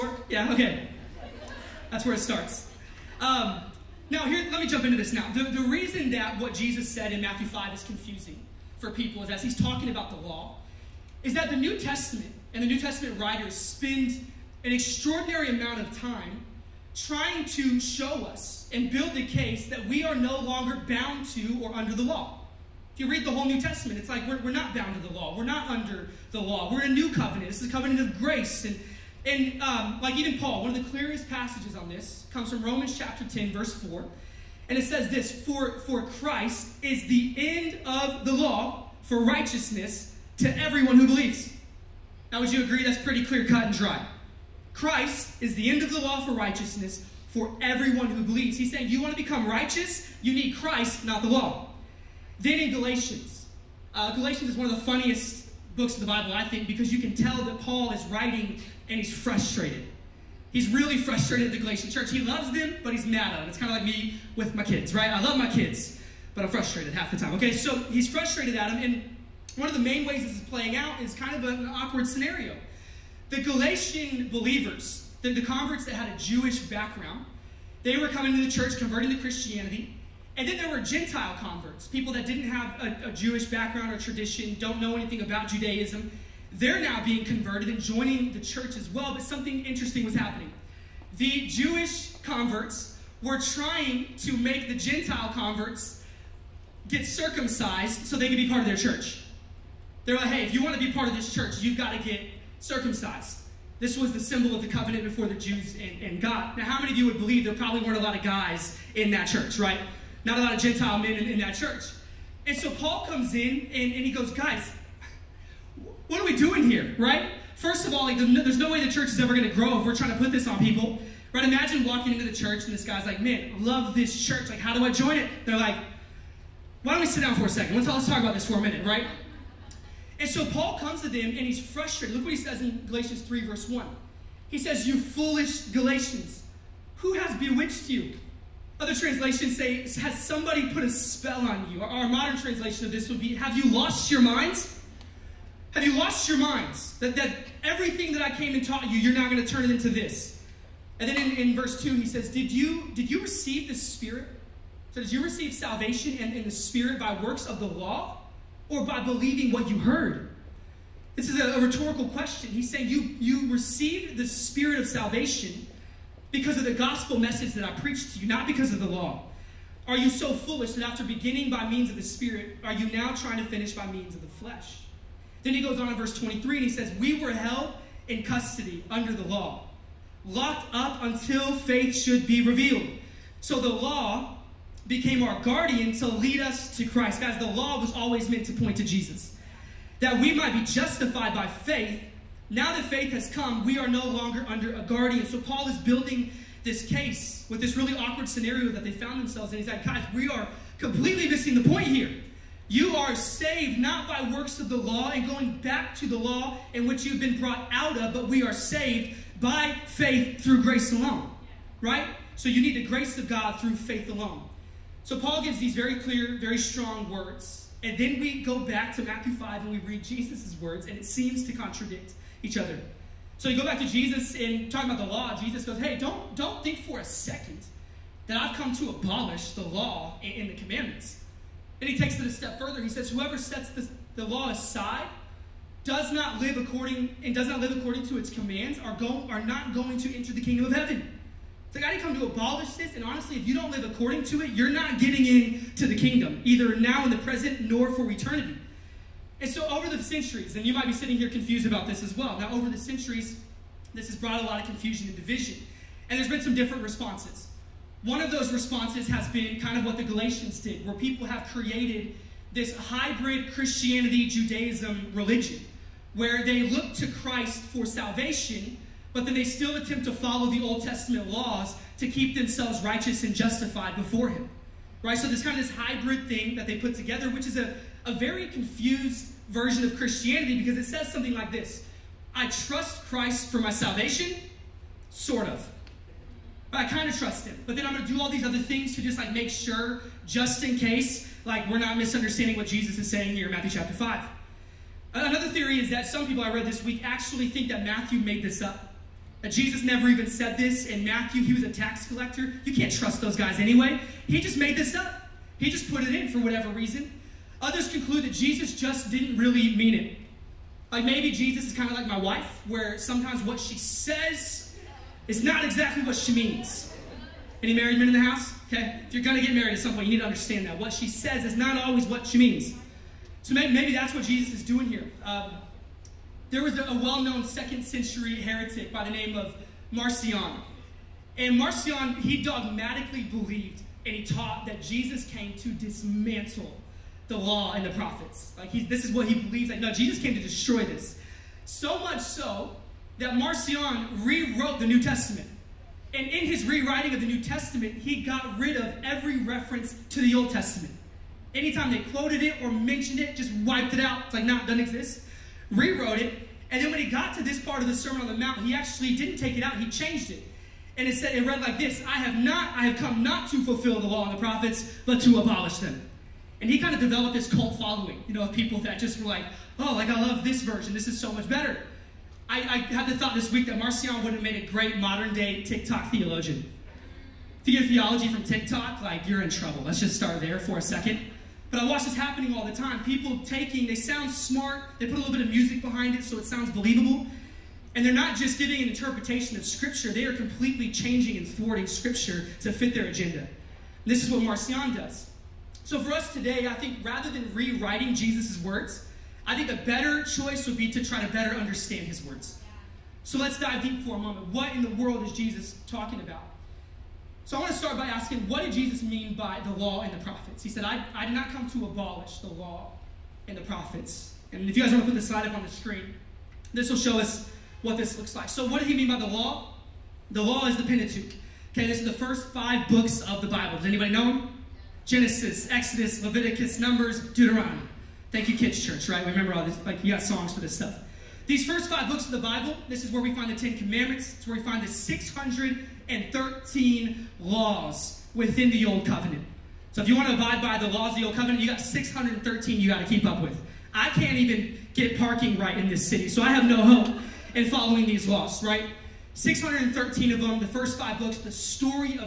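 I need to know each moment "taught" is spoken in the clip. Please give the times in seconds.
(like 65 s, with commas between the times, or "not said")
148 s, 334 s.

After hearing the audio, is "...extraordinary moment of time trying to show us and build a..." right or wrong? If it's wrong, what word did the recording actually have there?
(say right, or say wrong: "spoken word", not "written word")
wrong: "amount", not "moment".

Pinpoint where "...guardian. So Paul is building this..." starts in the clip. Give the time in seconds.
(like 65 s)
194 s.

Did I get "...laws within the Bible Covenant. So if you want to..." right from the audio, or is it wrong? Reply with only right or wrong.
wrong.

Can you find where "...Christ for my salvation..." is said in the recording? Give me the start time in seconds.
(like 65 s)
283 s.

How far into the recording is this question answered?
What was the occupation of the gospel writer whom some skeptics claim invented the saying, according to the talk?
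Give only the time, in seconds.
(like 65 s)
301 s.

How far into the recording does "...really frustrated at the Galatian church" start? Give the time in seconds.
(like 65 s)
60 s.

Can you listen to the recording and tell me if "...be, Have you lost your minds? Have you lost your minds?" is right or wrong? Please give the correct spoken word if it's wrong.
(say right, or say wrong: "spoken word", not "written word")
right.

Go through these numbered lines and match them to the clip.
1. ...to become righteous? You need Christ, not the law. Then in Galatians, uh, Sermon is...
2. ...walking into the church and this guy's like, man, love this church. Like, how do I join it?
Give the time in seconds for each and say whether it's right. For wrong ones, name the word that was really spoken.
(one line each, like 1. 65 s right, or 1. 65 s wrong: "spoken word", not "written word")
1. 49 s wrong: "Galatians", not "Sermon"
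2. 121 s right.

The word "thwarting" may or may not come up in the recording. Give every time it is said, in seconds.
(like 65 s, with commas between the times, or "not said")
391 s.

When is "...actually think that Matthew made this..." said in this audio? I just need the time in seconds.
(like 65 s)
297 s.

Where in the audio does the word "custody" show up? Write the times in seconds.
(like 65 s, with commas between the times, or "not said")
178 s.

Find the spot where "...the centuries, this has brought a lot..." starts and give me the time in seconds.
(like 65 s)
252 s.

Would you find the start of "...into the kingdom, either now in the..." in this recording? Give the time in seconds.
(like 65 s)
245 s.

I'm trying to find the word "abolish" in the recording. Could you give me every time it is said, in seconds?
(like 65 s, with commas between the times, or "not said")
228 s, 242 s, 365 s, 411 s.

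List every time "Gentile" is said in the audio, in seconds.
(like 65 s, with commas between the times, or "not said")
80 s, 94 s, 110 s.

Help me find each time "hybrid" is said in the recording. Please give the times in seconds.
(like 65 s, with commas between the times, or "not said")
262 s, 275 s.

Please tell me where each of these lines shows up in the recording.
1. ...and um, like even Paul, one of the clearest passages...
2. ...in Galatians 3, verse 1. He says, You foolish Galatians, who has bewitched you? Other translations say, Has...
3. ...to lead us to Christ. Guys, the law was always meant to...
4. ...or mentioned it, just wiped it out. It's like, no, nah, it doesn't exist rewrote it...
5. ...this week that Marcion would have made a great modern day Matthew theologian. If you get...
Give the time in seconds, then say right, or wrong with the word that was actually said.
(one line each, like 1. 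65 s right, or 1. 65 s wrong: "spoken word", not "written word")
1. 29 s right
2. 132 s right
3. 185 s right
4. 352 s right
5. 373 s wrong: "TikTok", not "Matthew".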